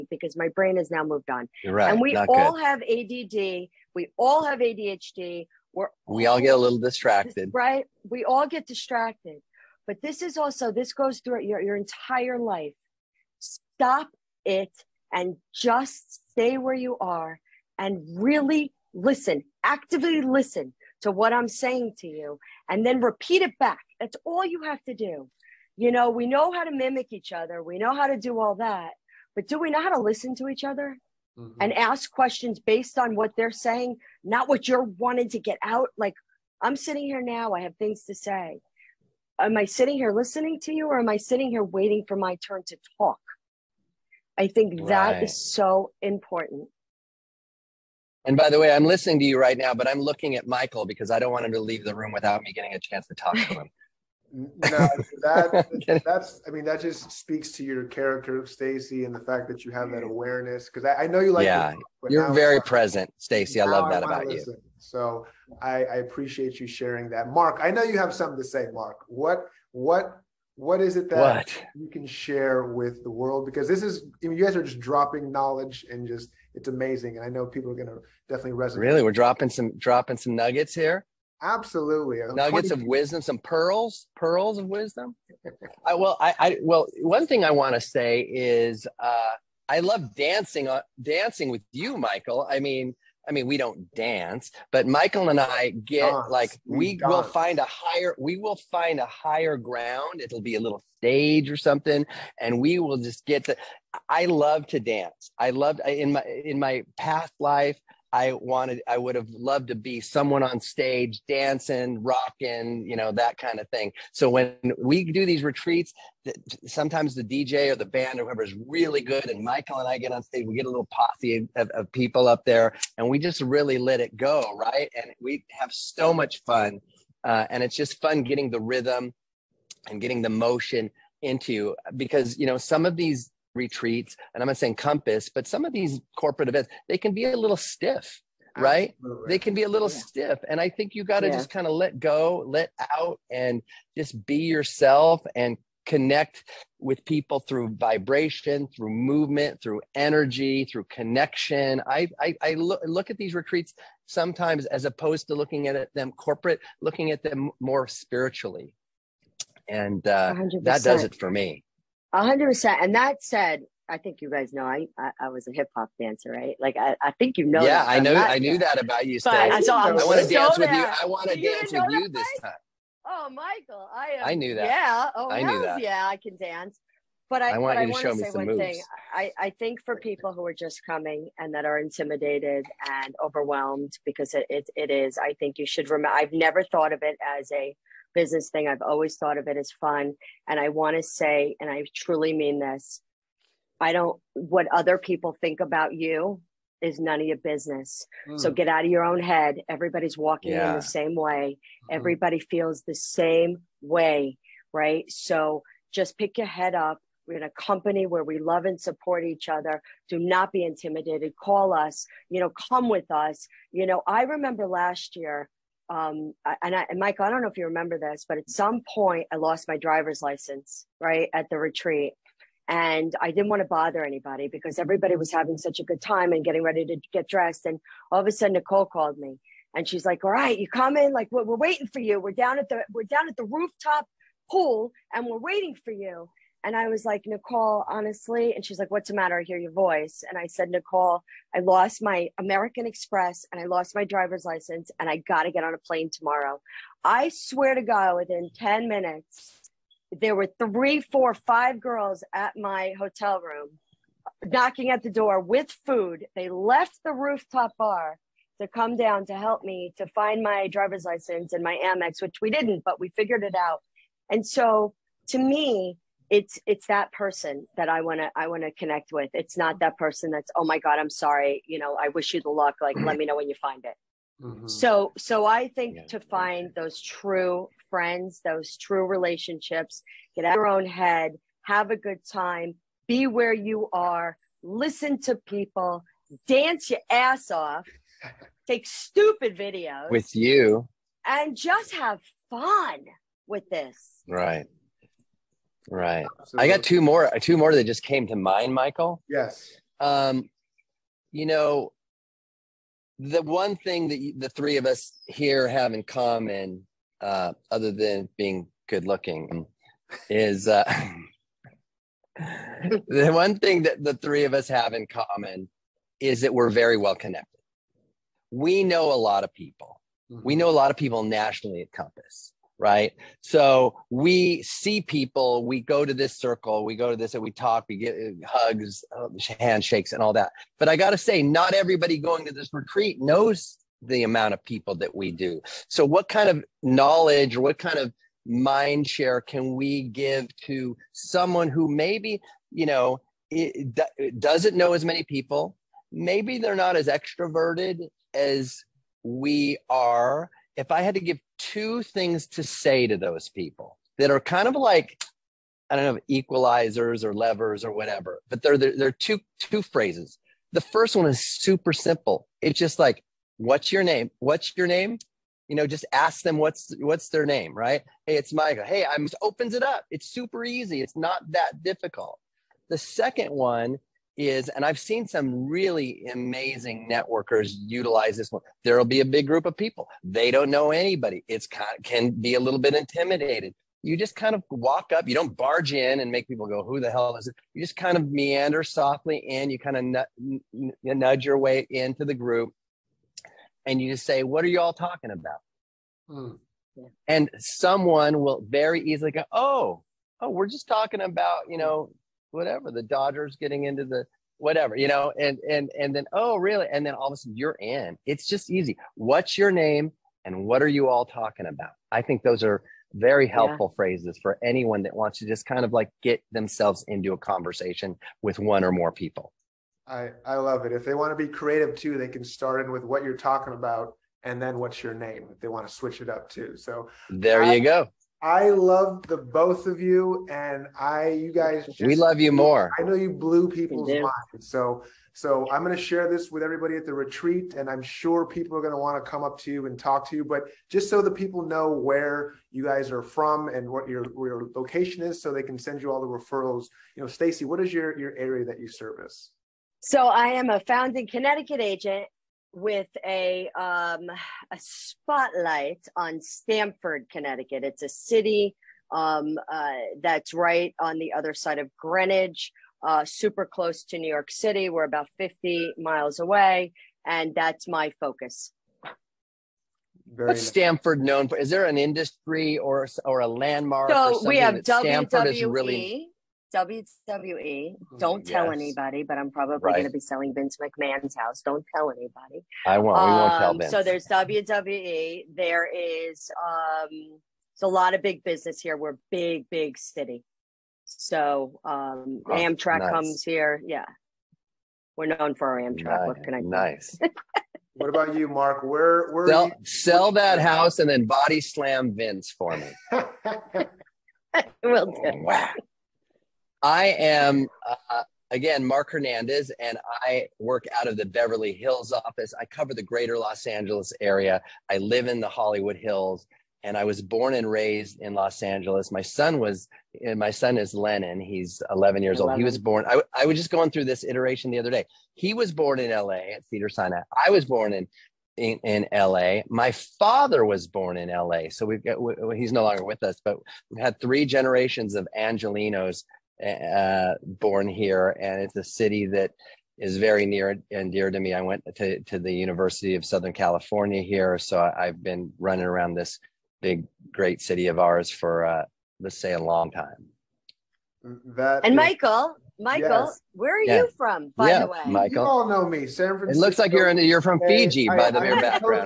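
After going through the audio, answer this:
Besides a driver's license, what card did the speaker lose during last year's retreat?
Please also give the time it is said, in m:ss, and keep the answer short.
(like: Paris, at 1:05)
American Express, at 4:02.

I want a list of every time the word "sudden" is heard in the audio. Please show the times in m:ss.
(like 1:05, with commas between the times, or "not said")
3:48, 6:47.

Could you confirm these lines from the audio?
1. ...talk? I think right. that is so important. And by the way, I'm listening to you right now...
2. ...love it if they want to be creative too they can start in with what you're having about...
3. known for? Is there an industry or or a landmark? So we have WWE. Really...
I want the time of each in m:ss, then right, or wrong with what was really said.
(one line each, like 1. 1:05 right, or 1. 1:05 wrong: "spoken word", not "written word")
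1. 0:42 right
2. 7:00 wrong: "talking", not "having"
3. 7:51 right.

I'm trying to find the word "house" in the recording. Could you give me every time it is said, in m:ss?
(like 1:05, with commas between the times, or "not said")
8:01, 8:20.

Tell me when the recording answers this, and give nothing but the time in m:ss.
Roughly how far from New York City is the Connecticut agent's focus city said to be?
7:45.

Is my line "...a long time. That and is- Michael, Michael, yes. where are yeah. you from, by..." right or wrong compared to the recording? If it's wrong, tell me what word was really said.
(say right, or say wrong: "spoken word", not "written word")
right.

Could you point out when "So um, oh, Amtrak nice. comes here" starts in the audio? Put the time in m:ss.
8:11.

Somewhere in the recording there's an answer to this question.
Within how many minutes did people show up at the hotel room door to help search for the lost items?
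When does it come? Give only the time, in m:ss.
4:08.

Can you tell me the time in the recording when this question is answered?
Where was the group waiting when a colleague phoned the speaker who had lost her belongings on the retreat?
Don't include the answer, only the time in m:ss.
3:53.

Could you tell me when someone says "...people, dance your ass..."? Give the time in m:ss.
4:45.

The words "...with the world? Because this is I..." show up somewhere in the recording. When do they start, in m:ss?
1:12.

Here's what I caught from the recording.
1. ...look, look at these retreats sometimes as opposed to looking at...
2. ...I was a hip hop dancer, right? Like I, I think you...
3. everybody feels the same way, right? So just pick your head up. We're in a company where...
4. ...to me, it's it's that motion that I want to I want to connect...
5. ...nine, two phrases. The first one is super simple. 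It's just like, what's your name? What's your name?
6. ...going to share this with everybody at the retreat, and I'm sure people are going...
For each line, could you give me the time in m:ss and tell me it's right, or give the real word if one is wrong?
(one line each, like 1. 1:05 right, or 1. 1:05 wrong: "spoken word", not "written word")
1. 2:32 right
2. 2:45 right
3. 3:21 right
4. 4:25 wrong: "person", not "motion"
5. 5:59 wrong: "two", not "nine"
6. 7:15 right.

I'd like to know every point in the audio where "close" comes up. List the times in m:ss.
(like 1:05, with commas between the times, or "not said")
7:43.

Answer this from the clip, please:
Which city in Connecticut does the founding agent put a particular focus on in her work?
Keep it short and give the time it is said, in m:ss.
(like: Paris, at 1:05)
Stamford, at 7:36.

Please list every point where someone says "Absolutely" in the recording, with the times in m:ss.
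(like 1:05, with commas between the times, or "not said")
1:21, 2:18.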